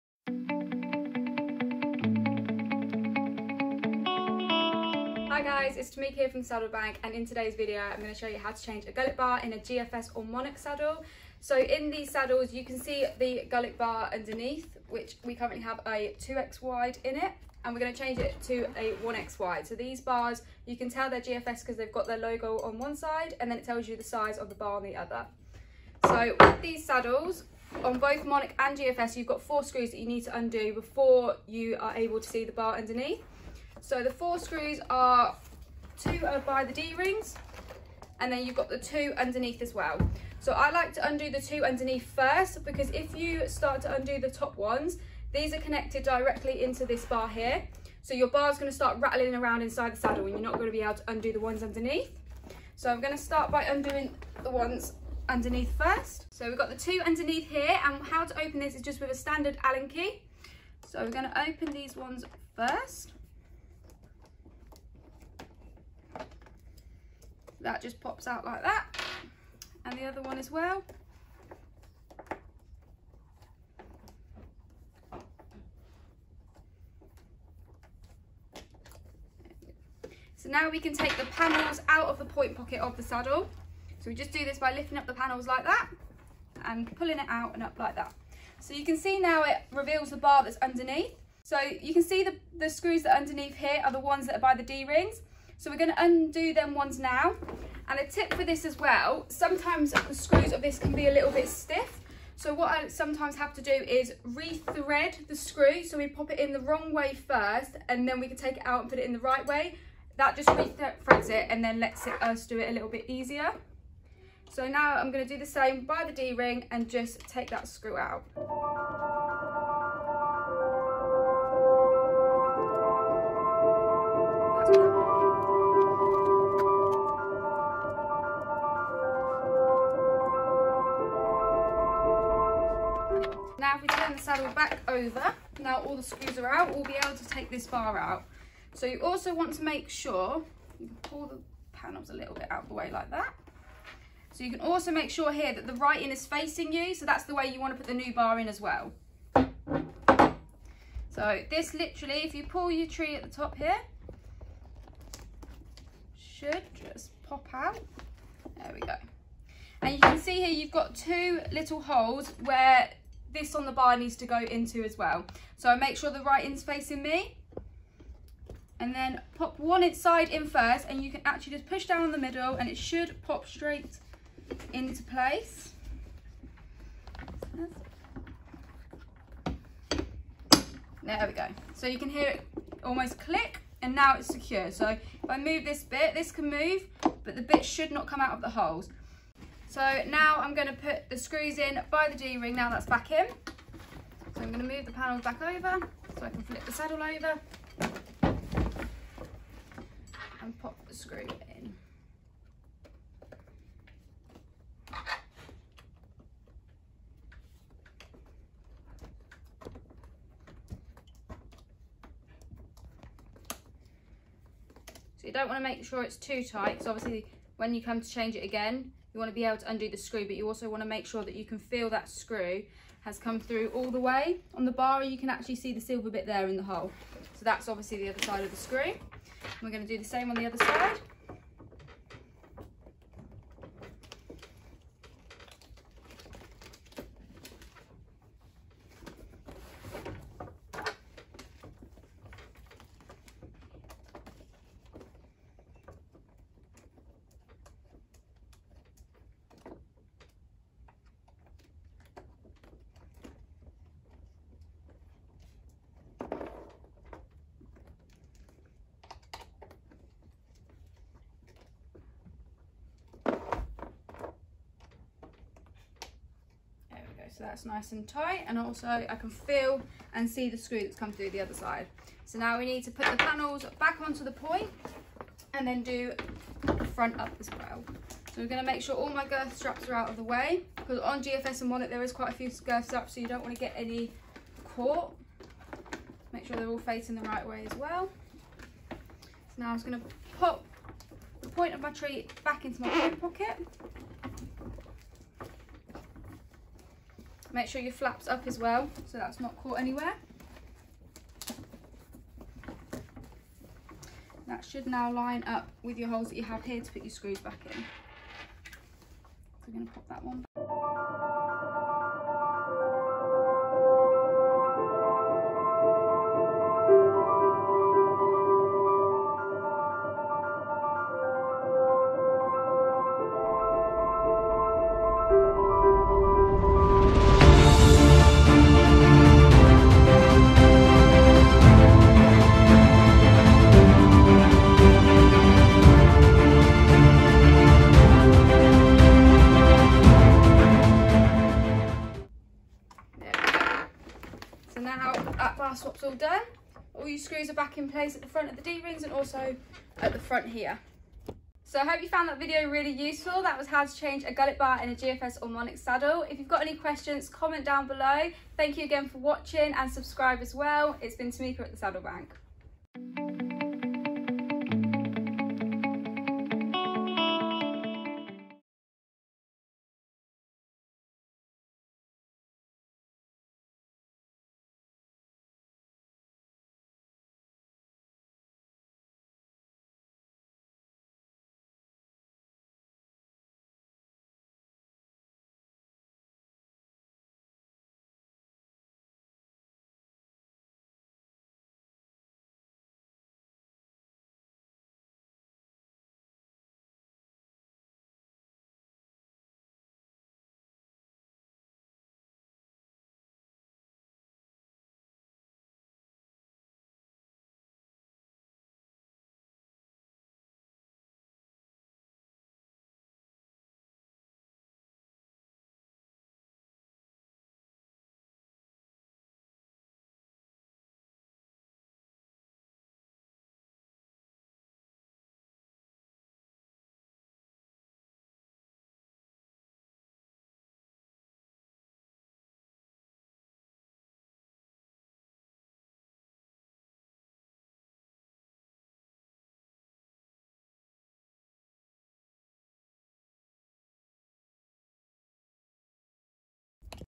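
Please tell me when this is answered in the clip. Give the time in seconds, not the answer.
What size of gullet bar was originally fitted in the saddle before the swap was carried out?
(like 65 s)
16 s.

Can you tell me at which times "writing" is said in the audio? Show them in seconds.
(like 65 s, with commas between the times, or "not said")
145 s, 166 s.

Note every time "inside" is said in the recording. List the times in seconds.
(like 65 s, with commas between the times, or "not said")
49 s, 169 s.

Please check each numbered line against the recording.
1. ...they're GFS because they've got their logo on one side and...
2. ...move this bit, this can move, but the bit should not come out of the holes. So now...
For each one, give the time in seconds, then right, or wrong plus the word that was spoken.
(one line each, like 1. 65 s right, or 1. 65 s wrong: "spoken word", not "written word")
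1. 21 s right
2. 185 s right.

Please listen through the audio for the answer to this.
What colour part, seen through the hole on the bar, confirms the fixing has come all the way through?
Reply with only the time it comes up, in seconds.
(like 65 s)
225 s.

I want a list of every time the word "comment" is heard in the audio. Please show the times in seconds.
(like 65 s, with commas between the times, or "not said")
357 s.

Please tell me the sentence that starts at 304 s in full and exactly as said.
That should now line up with your holes that you have here to put your screws back in.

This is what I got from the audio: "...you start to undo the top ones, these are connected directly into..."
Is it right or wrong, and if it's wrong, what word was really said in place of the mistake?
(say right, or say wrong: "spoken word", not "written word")
right.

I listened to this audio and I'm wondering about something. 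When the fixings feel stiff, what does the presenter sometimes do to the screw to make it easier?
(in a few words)
Re-thread the screw.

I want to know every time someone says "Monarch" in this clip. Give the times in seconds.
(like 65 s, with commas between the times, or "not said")
10 s, 28 s, 355 s.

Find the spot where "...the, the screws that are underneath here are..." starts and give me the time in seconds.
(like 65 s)
92 s.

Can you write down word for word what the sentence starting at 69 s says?
And the other one as well.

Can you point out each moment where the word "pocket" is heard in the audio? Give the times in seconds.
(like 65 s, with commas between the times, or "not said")
82 s, 293 s.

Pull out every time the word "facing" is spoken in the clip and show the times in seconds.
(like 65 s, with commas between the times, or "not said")
146 s, 166 s, 286 s.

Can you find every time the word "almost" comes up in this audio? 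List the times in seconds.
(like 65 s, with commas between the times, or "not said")
182 s.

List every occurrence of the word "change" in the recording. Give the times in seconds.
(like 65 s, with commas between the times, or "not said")
8 s, 17 s, 218 s, 353 s.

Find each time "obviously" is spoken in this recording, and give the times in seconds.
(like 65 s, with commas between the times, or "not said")
216 s, 227 s.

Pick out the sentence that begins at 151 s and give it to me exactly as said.
So this literally, if you pull your tree at the top here, should just pop out.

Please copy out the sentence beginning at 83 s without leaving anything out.
So we just do this by lifting up the panels like that and pulling it out and up like that.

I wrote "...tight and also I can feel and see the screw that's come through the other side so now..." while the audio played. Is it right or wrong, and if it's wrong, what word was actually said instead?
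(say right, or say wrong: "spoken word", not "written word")
right.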